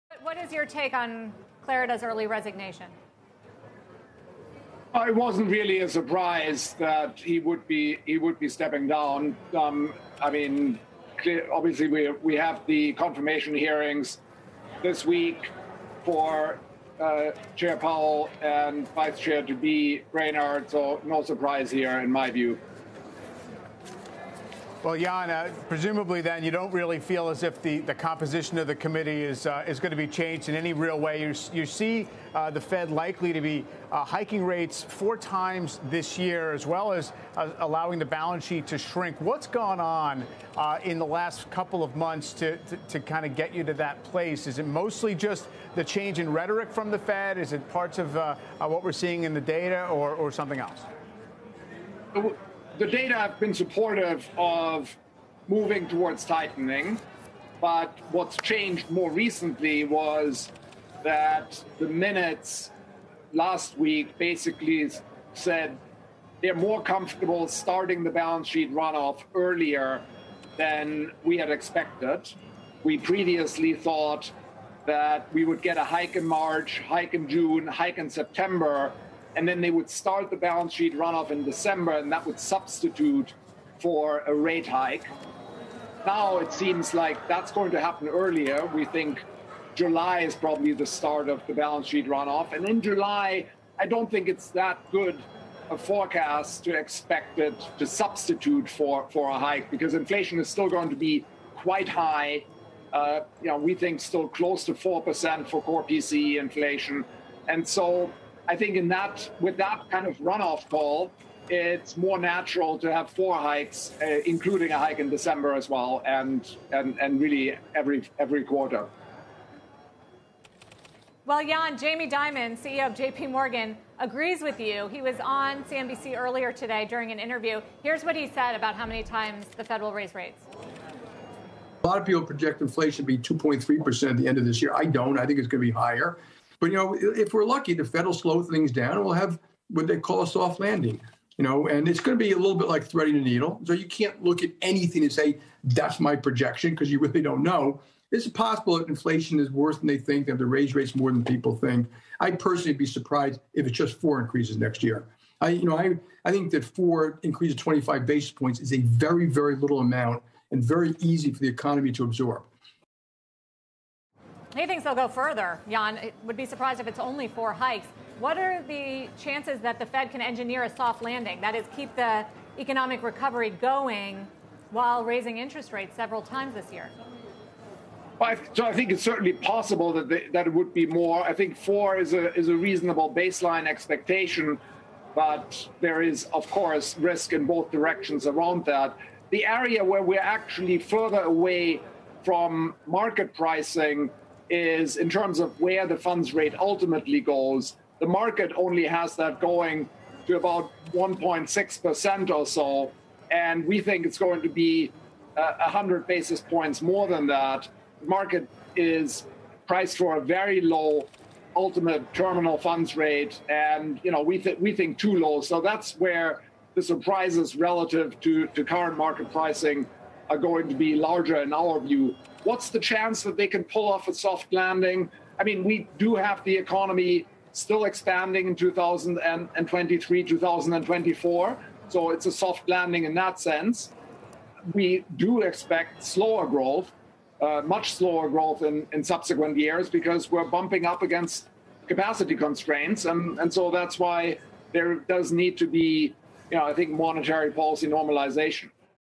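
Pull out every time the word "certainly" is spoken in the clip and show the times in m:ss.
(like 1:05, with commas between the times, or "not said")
2:59.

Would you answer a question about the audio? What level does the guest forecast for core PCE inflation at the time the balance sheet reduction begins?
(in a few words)
close to 4%.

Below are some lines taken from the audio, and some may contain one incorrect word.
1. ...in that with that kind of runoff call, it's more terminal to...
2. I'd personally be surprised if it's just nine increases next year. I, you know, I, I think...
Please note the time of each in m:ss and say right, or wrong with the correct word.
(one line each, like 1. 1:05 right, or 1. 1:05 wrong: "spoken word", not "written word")
1. 1:48 wrong: "natural", not "terminal"
2. 2:32 wrong: "four", not "nine".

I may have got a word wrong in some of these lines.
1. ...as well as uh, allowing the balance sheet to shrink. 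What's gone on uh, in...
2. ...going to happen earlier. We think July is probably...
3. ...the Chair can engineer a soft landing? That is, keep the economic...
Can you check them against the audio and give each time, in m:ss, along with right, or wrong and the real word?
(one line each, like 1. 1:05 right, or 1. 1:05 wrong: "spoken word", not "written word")
1. 0:36 right
2. 1:27 right
3. 2:49 wrong: "Fed", not "Chair".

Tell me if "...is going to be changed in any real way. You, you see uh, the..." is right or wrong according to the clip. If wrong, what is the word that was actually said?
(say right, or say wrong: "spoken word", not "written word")
right.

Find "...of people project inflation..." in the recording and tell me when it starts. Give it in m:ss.
2:11.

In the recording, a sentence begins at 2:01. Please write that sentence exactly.
Well, Jan, Jamie Dimon, CEO of JP Morgan, agrees with you.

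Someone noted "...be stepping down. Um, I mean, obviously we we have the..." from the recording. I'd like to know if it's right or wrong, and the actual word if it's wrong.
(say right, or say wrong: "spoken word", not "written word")
right.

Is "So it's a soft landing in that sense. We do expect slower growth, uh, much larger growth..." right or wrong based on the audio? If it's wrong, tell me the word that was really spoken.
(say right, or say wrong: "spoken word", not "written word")
wrong: "slower", not "larger".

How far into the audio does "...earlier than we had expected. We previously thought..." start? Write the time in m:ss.
1:09.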